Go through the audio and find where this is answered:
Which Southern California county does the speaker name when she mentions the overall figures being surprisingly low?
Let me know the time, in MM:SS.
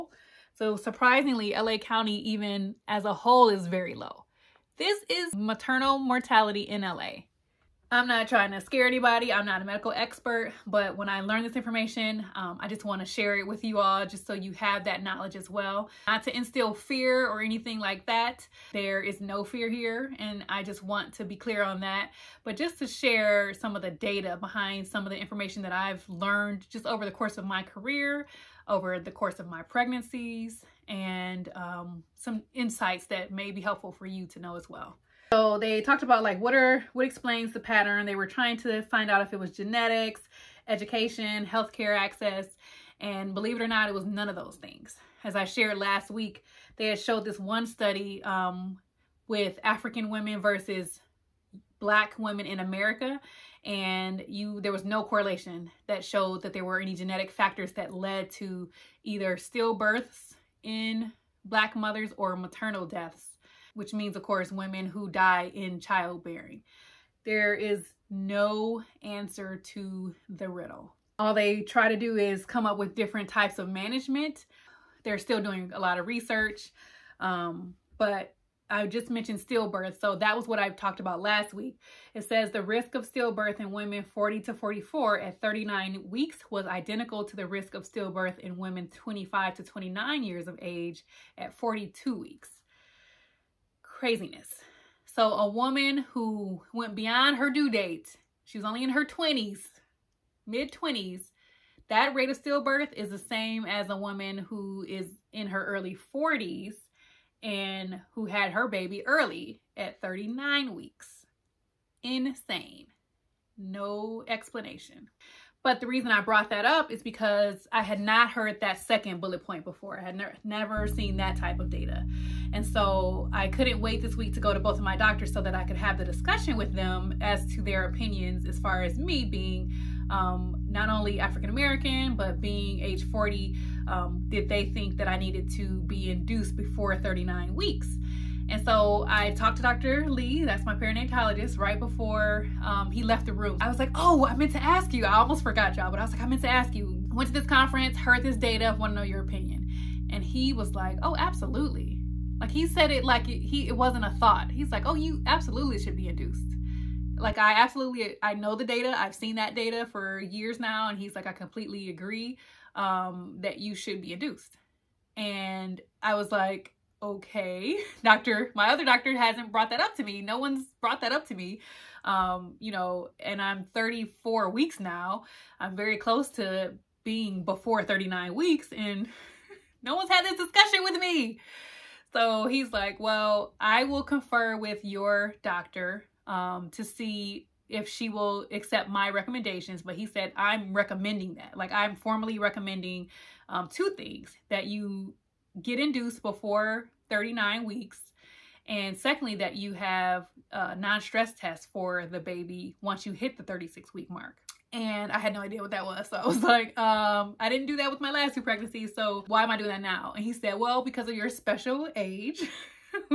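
00:01.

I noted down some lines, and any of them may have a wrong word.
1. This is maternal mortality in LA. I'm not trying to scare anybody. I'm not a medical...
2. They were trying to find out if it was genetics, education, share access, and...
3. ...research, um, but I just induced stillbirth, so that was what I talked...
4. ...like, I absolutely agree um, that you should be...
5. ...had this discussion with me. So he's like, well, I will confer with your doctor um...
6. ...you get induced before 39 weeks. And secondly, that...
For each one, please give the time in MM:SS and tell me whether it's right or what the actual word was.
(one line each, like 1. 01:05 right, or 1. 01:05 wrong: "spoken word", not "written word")
1. 00:04 right
2. 00:38 wrong: "healthcare", not "share"
3. 01:16 wrong: "mentioned", not "induced"
4. 02:41 wrong: "completely", not "absolutely"
5. 03:00 right
6. 03:14 right.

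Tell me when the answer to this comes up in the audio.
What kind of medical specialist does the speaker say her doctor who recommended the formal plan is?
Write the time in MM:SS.
02:20.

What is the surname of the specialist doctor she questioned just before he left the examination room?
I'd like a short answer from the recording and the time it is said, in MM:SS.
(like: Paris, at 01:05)
Lee, at 02:20.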